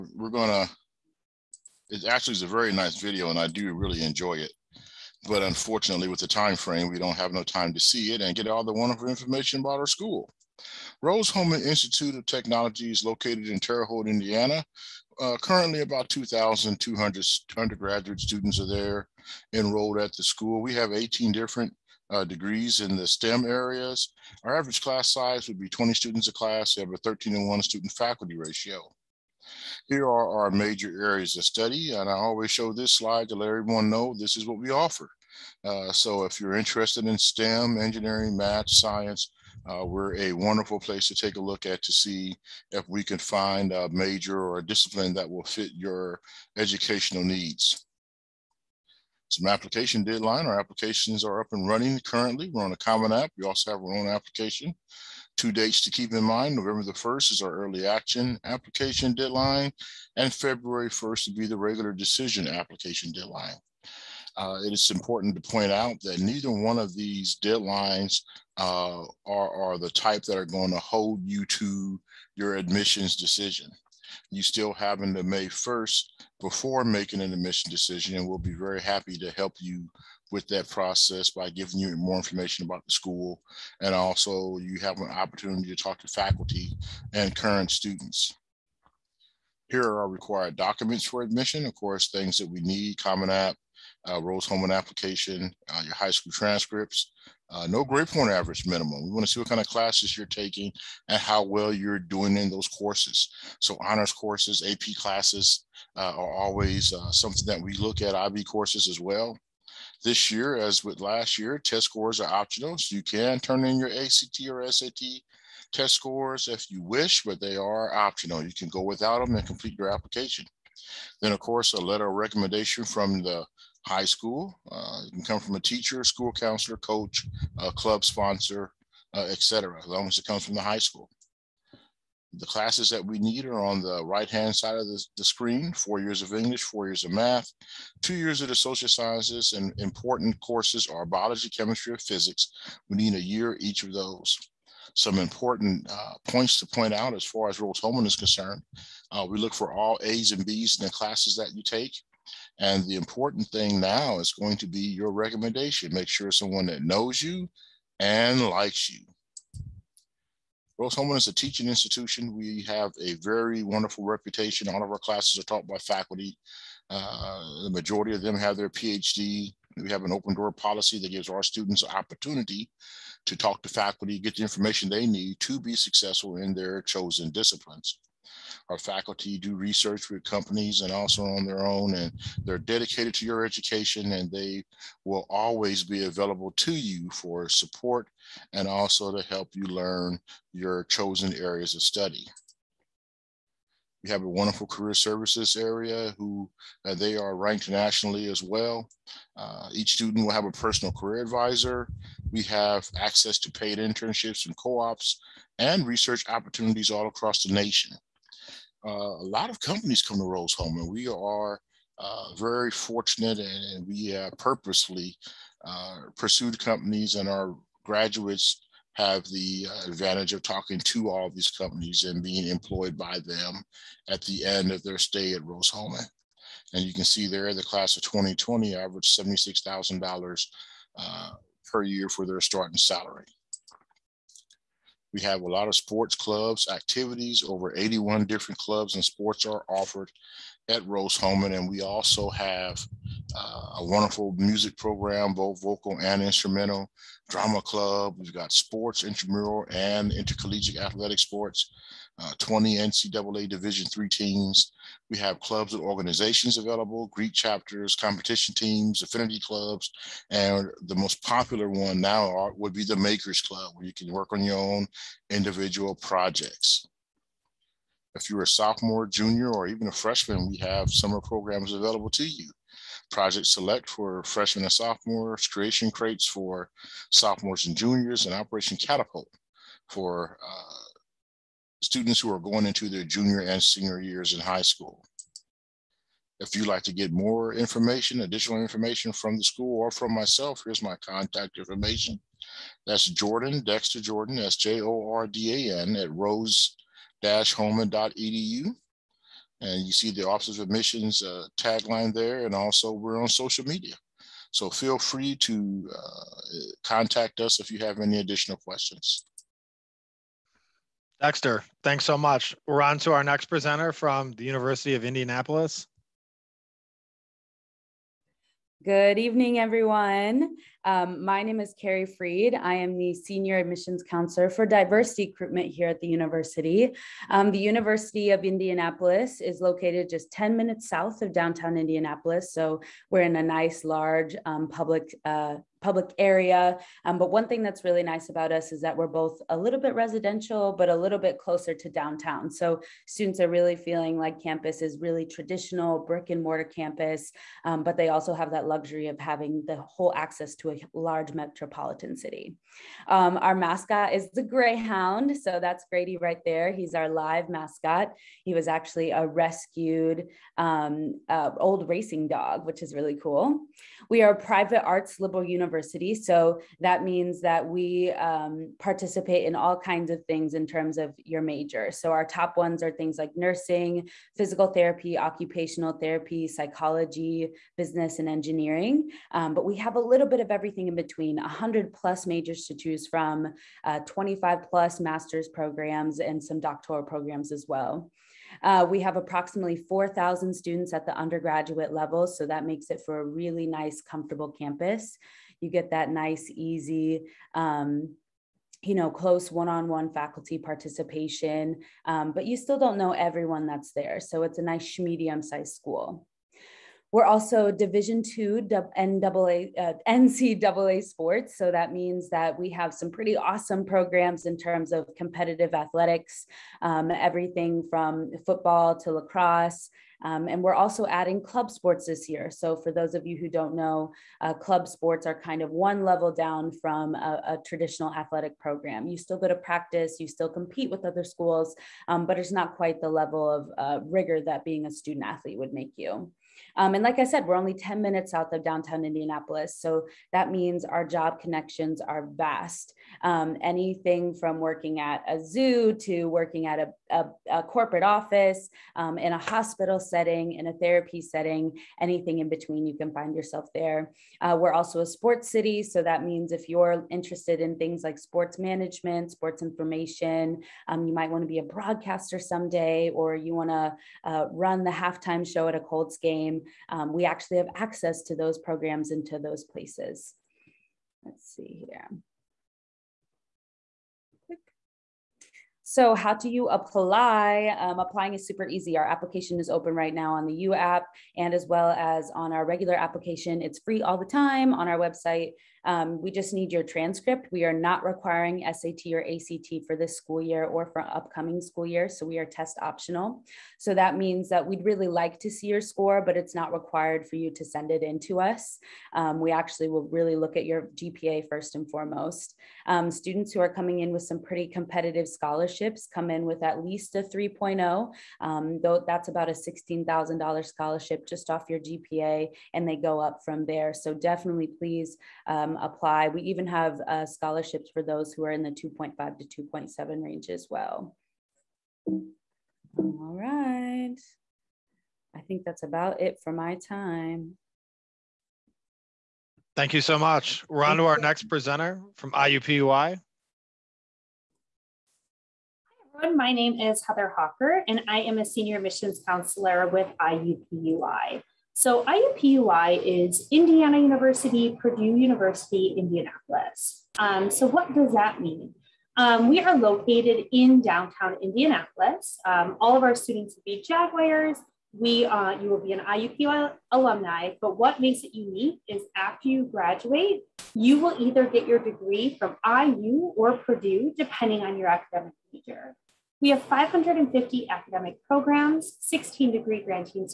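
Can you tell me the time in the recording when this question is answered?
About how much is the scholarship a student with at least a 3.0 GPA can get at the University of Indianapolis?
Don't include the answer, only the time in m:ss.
8:29.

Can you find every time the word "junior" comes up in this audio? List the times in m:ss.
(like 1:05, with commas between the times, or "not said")
4:29, 4:37, 4:43.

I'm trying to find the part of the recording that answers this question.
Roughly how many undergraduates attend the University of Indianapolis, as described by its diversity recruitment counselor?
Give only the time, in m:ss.
6:29.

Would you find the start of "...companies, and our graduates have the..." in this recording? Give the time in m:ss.
3:36.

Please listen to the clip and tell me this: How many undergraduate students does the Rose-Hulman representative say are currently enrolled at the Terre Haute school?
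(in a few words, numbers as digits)
2200.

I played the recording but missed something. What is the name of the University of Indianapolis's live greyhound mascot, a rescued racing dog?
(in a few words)
Grady.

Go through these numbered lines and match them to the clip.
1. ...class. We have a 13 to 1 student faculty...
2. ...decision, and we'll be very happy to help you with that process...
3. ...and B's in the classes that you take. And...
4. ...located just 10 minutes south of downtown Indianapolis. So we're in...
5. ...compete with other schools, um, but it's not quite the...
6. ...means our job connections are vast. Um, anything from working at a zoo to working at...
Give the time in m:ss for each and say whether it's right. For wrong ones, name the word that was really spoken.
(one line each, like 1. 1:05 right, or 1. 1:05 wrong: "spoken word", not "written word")
1. 0:26 right
2. 1:17 right
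3. 2:30 right
4. 5:29 right
5. 7:10 right
6. 7:20 right.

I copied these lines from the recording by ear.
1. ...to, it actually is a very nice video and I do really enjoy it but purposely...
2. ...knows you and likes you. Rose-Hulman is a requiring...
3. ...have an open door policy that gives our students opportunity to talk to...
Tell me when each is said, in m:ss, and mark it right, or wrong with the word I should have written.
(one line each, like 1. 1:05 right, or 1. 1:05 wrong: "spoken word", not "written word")
1. 0:00 wrong: "unfortunately", not "purposely"
2. 2:36 wrong: "teaching", not "requiring"
3. 2:49 right.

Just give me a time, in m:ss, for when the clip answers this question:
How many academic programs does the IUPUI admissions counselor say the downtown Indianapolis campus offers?
9:26.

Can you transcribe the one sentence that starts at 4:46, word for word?
If you'd like to get more information, additional information from the school or from myself, here's my contact information.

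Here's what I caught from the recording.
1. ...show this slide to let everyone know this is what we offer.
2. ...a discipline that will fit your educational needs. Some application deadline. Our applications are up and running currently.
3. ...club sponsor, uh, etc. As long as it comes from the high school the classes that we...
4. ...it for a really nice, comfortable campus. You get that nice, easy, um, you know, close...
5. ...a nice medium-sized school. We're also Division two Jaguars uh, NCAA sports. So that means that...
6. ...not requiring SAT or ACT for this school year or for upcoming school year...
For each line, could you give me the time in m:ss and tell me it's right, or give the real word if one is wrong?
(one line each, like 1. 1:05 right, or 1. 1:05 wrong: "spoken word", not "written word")
1. 0:32 right
2. 0:44 right
3. 2:07 right
4. 6:32 right
5. 6:44 wrong: "NCAA", not "Jaguars"
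6. 8:07 right.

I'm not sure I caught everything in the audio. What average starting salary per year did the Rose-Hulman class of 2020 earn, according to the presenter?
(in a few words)
$76,000.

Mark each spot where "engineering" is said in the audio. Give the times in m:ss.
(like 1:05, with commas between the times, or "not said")
0:37, 6:18.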